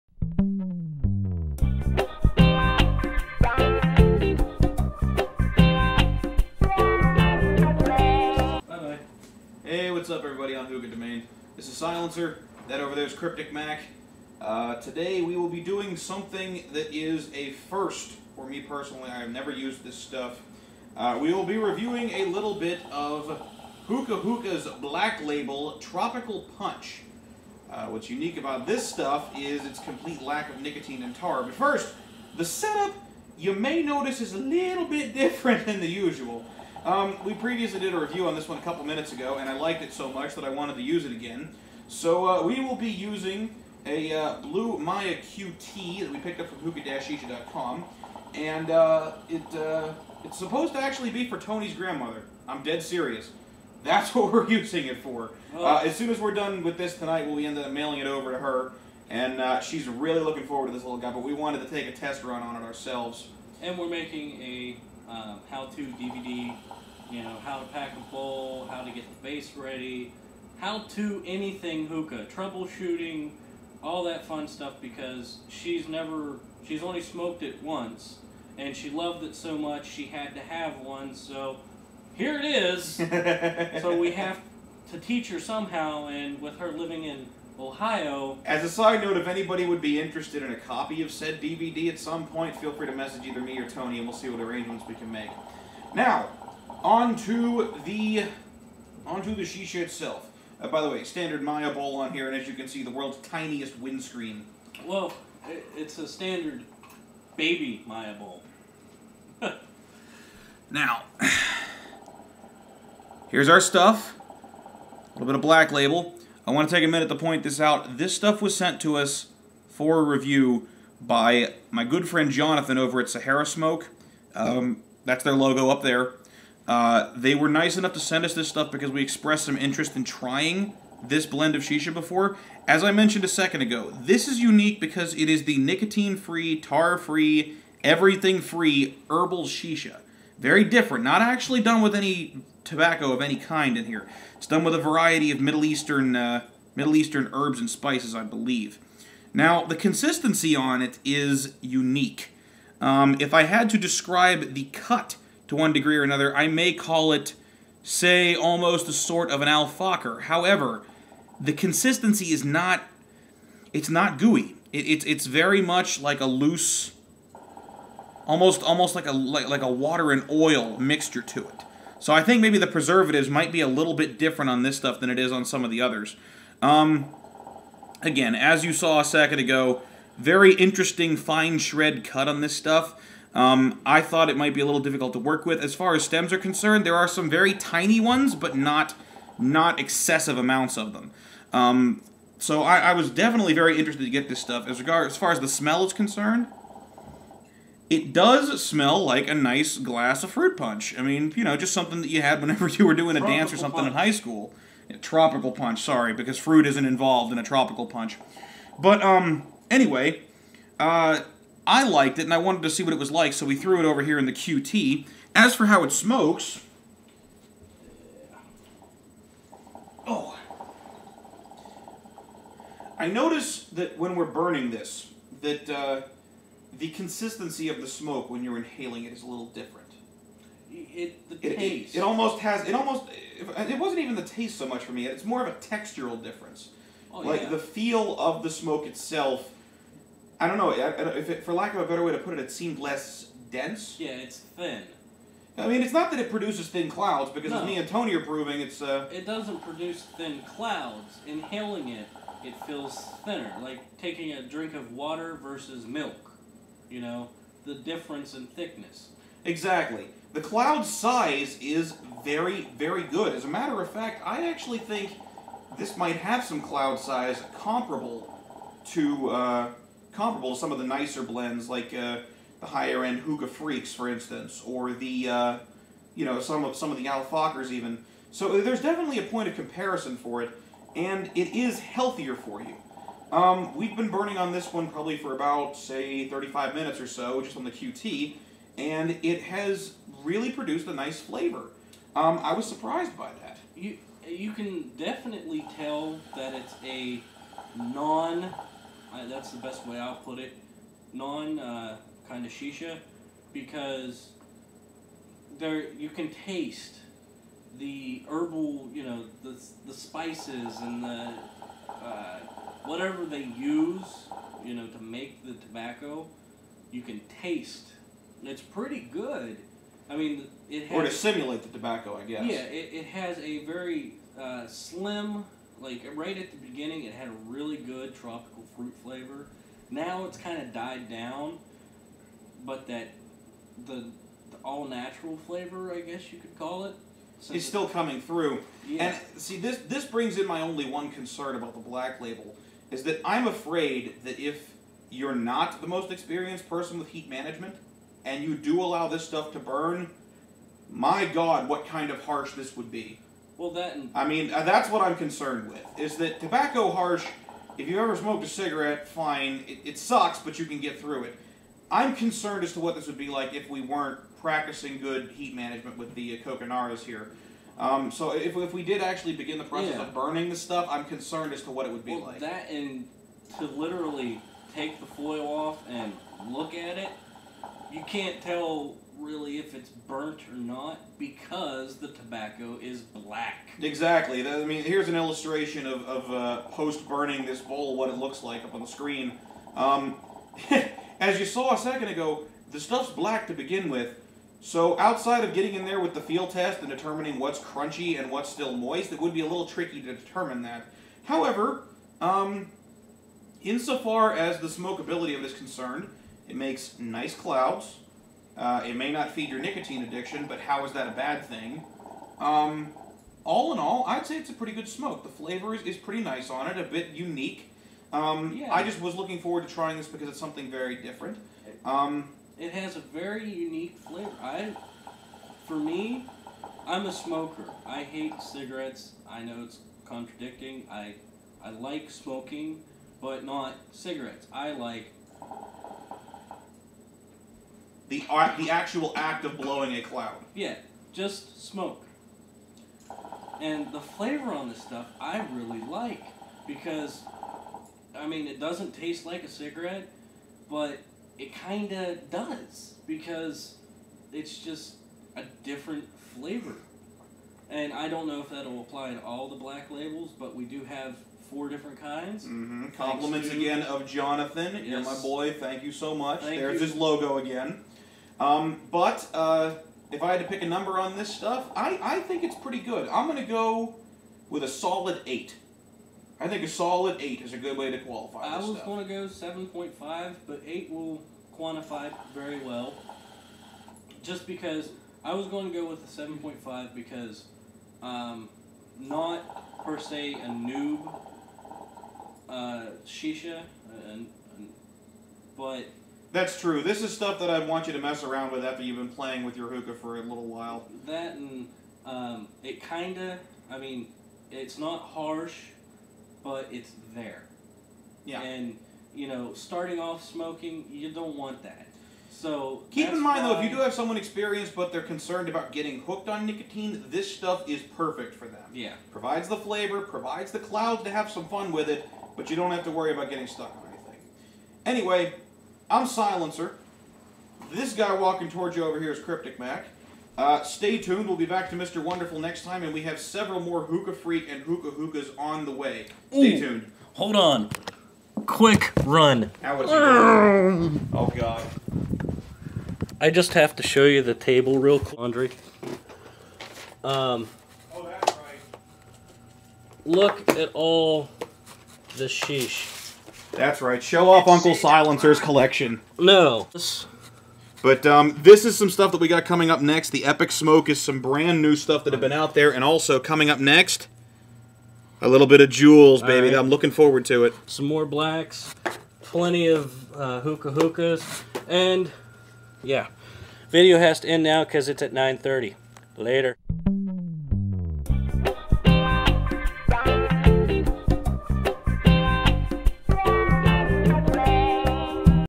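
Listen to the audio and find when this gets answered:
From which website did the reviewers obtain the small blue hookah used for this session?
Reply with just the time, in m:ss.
0:46.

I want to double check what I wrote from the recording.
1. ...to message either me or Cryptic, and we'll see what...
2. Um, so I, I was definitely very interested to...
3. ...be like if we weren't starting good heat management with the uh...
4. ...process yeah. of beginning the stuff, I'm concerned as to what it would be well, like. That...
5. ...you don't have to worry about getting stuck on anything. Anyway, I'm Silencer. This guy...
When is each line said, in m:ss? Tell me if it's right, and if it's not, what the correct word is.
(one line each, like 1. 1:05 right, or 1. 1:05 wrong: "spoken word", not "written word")
1. 1:32 wrong: "Tony", not "Cryptic"
2. 3:11 right
3. 6:03 wrong: "practicing", not "starting"
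4. 6:09 wrong: "burning", not "beginning"
5. 8:42 right.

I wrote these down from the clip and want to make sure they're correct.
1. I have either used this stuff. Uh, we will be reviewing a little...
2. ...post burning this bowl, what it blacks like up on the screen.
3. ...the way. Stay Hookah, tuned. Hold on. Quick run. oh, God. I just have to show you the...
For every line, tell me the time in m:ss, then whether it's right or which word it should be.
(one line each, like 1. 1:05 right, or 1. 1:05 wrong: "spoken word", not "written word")
1. 0:19 wrong: "never", not "either"
2. 6:26 wrong: "looks", not "blacks"
3. 8:55 wrong: "Ooh", not "Hookah".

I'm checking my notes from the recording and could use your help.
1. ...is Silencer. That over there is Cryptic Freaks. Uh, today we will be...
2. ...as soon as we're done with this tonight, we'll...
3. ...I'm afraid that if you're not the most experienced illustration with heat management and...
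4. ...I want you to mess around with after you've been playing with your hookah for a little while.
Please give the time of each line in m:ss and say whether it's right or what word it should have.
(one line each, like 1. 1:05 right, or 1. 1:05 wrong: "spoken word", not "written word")
1. 0:11 wrong: "Mac", not "Freaks"
2. 0:55 right
3. 5:43 wrong: "person", not "illustration"
4. 8:17 right.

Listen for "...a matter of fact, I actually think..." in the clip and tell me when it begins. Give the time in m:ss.
4:23.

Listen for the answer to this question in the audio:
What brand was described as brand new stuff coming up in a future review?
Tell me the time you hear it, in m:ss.
9:20.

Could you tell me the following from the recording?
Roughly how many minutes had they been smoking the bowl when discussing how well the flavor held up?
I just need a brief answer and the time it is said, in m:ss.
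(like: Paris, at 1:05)
35, at 4:46.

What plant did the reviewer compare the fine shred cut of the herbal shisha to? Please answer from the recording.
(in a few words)
alfalfa.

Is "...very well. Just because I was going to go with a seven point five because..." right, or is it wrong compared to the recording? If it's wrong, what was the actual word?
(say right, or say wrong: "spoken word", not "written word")
right.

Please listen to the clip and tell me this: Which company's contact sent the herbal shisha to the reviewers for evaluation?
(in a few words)
Sahara Smoke.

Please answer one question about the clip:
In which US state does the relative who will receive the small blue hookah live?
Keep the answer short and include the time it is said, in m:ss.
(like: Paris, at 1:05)
Ohio, at 1:27.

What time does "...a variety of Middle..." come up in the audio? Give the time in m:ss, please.
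2:24.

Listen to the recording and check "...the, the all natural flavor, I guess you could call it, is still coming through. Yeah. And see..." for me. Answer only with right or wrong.
right.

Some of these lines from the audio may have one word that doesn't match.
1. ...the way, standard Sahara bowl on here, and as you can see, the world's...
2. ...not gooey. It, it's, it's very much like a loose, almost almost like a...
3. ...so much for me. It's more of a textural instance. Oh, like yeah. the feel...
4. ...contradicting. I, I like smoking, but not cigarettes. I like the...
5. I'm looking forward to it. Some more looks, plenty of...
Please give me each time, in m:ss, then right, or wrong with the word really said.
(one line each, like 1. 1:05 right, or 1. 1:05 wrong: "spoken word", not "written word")
1. 1:40 wrong: "Mya", not "Sahara"
2. 2:43 right
3. 3:54 wrong: "difference", not "instance"
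4. 7:10 right
5. 9:26 wrong: "blacks", not "looks".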